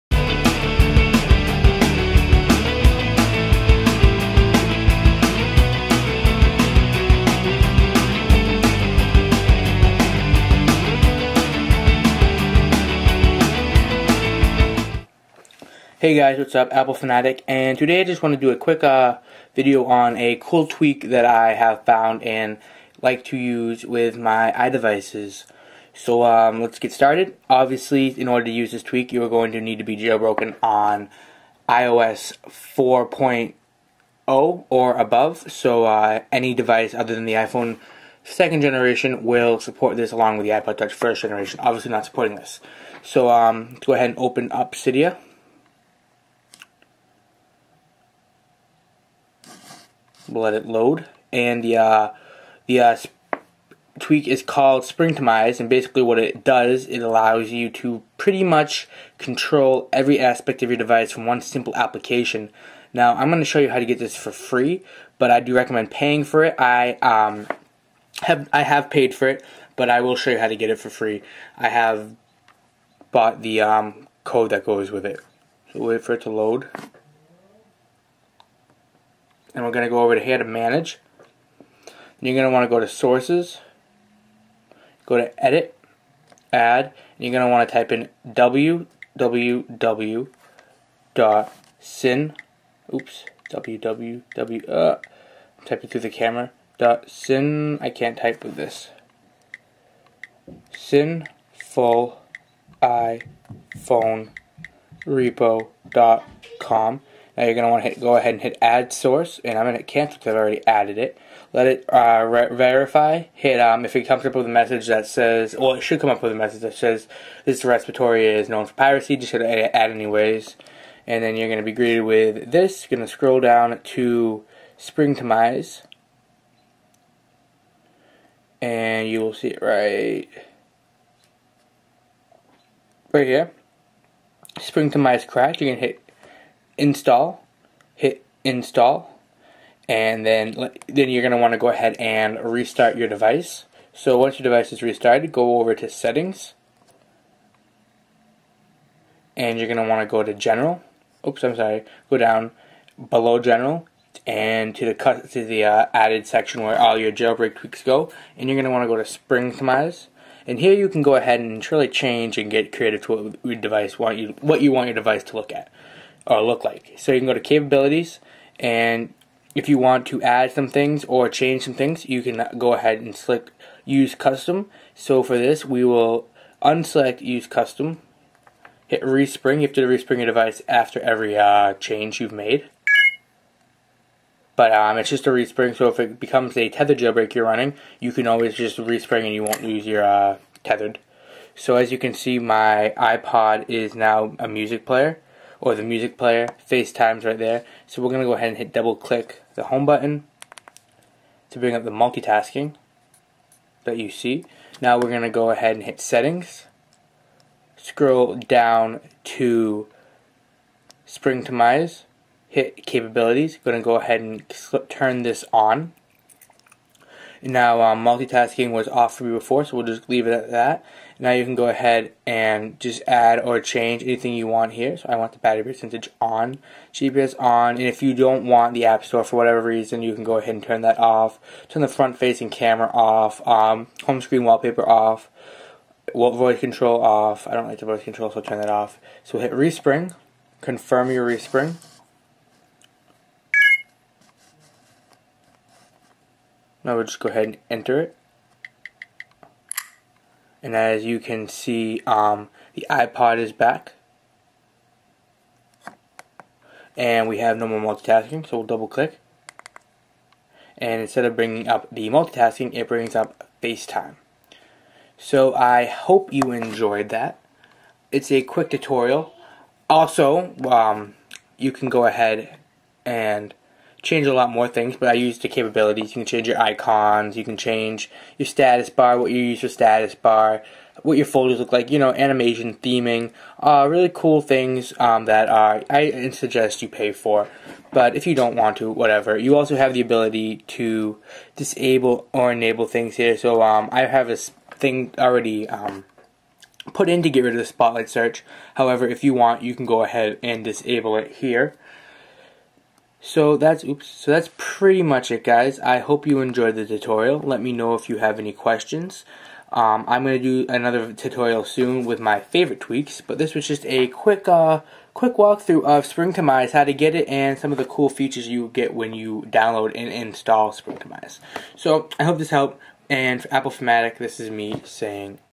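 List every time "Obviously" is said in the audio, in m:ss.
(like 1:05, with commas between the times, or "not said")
0:27, 0:41.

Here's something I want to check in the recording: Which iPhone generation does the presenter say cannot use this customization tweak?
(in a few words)
second generation.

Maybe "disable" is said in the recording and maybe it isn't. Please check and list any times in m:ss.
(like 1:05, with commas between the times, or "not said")
4:51, 5:00.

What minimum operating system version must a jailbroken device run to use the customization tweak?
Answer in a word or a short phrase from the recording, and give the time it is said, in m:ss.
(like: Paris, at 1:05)
iOS 4.0, at 0:31.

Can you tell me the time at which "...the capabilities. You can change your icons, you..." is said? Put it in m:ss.
4:35.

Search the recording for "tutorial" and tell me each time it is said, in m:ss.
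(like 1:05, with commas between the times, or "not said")
4:28, 5:06, 5:11.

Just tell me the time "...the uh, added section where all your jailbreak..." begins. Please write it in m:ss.
2:35.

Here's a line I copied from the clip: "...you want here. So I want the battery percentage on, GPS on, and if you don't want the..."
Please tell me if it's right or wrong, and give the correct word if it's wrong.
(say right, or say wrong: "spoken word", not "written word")
right.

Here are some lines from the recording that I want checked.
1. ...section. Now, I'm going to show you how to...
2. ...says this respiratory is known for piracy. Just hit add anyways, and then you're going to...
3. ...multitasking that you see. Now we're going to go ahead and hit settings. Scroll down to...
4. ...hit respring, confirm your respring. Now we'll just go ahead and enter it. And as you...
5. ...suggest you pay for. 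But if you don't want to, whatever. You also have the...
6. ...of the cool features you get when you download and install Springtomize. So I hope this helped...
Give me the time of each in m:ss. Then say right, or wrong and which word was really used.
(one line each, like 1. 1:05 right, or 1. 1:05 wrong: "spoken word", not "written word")
1. 1:01 wrong: "application", not "section"
2. 1:56 right
3. 3:21 right
4. 3:59 right
5. 4:46 right
6. 5:17 right.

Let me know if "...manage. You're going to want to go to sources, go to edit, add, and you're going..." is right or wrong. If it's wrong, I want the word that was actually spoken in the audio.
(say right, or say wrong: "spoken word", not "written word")
right.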